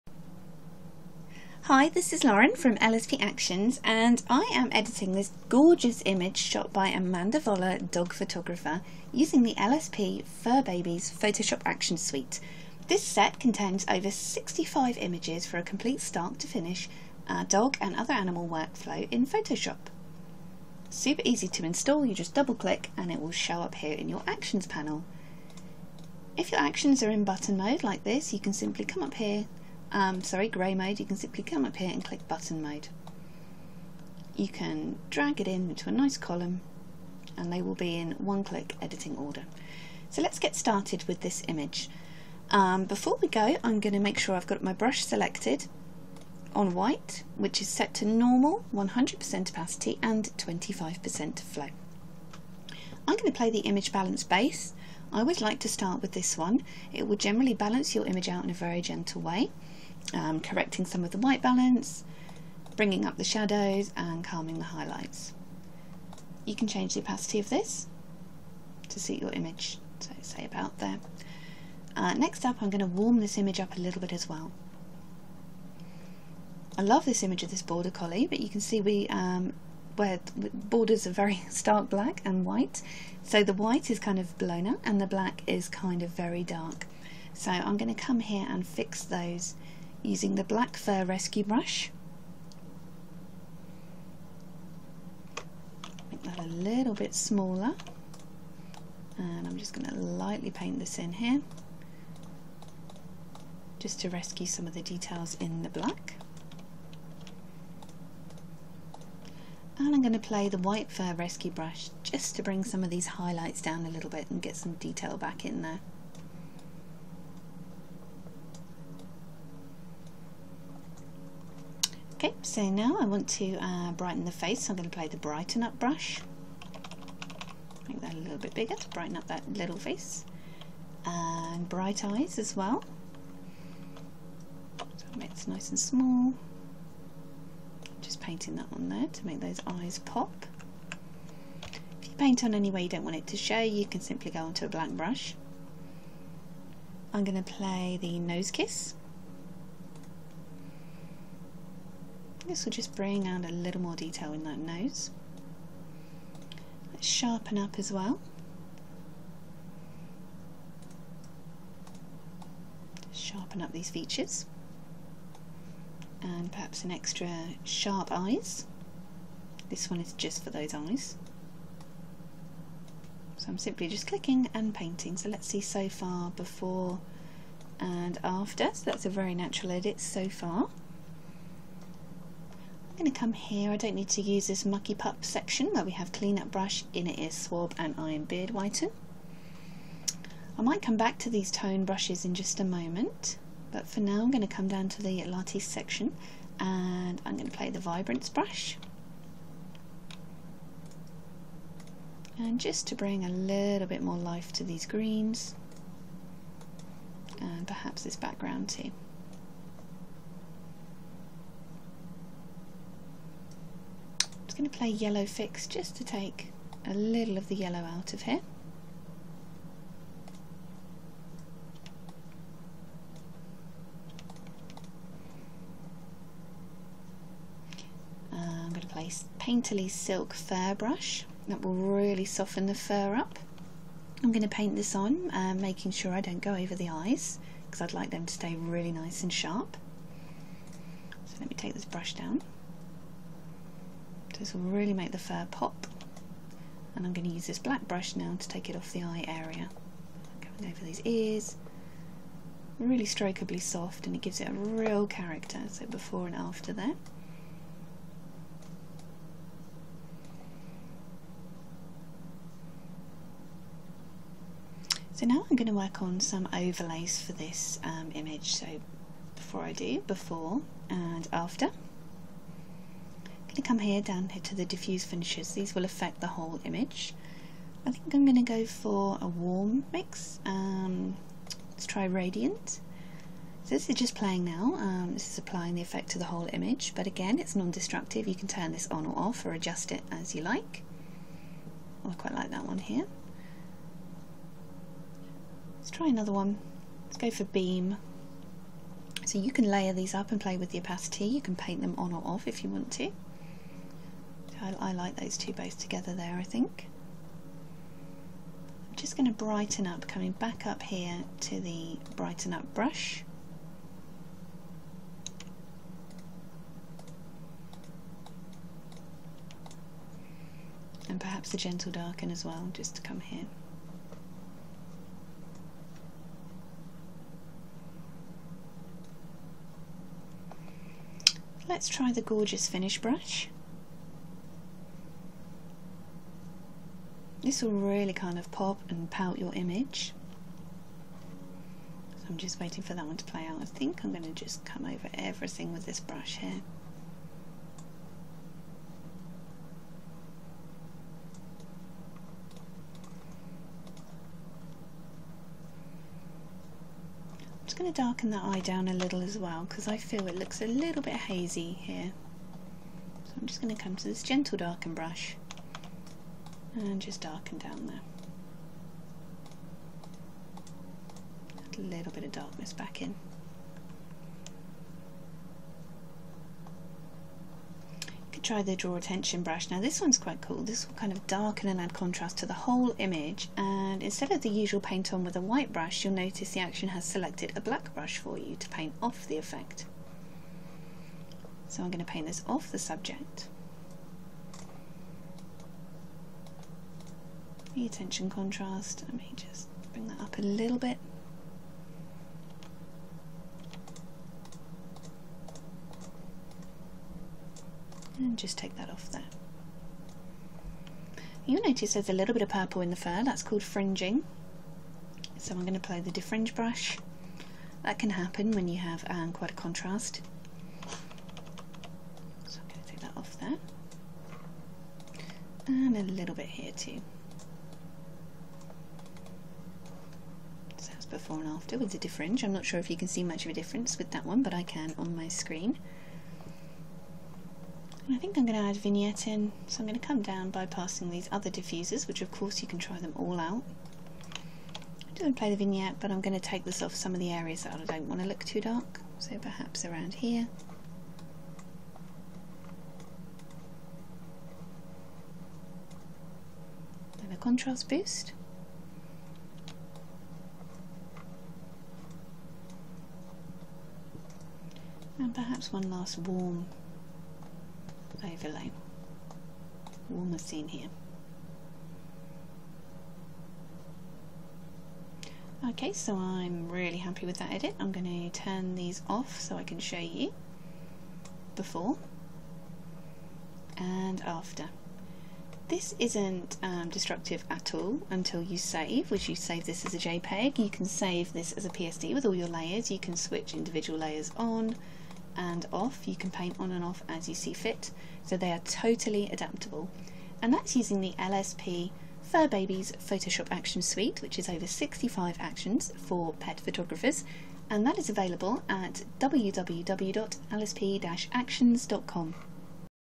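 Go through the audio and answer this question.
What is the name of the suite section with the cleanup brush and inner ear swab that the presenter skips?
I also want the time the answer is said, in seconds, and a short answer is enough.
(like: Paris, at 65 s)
Mucky pup, at 184 s.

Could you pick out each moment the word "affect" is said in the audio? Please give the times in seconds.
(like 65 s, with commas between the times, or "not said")
275 s.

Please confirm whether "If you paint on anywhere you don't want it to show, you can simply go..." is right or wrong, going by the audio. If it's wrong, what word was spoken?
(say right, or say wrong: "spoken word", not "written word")
right.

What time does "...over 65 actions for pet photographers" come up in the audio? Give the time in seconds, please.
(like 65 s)
504 s.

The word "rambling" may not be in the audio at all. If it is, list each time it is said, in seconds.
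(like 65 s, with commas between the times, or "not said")
not said.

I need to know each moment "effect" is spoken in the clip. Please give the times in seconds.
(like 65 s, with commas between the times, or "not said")
285 s, 389 s.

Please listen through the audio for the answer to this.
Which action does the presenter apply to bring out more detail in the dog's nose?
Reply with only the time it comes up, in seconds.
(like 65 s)
148 s.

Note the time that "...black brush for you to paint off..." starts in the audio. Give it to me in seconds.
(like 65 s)
387 s.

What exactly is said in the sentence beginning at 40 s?
So let's get started with this image.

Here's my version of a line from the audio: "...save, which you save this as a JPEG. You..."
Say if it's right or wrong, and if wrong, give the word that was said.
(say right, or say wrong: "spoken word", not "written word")
right.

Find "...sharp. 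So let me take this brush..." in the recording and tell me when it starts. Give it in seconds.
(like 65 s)
239 s.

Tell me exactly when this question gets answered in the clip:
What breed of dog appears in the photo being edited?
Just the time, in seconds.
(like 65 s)
77 s.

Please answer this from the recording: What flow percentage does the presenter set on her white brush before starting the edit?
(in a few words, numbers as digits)
25%.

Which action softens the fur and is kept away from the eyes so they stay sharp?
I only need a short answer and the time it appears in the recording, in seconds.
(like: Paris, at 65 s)
Painterly Silk Fur Brush, at 229 s.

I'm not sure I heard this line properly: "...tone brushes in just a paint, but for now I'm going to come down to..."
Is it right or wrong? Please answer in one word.
wrong.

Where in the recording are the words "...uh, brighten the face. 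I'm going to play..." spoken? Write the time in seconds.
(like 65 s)
123 s.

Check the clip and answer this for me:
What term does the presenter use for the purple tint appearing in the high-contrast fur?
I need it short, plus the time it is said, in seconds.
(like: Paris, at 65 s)
Fringing, at 413 s.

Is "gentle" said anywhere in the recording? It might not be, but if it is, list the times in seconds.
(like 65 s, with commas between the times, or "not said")
58 s, 321 s, 364 s.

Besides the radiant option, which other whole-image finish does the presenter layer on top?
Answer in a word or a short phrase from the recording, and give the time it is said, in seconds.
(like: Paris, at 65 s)
Beam, at 297 s.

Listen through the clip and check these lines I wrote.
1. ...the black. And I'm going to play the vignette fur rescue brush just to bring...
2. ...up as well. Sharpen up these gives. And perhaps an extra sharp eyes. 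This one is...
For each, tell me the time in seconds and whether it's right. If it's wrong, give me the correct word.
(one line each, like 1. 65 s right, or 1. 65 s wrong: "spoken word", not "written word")
1. 105 s wrong: "white", not "vignette"
2. 157 s wrong: "features", not "gives".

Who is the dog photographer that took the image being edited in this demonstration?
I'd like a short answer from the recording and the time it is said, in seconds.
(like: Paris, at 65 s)
Amanda Voller, at 6 s.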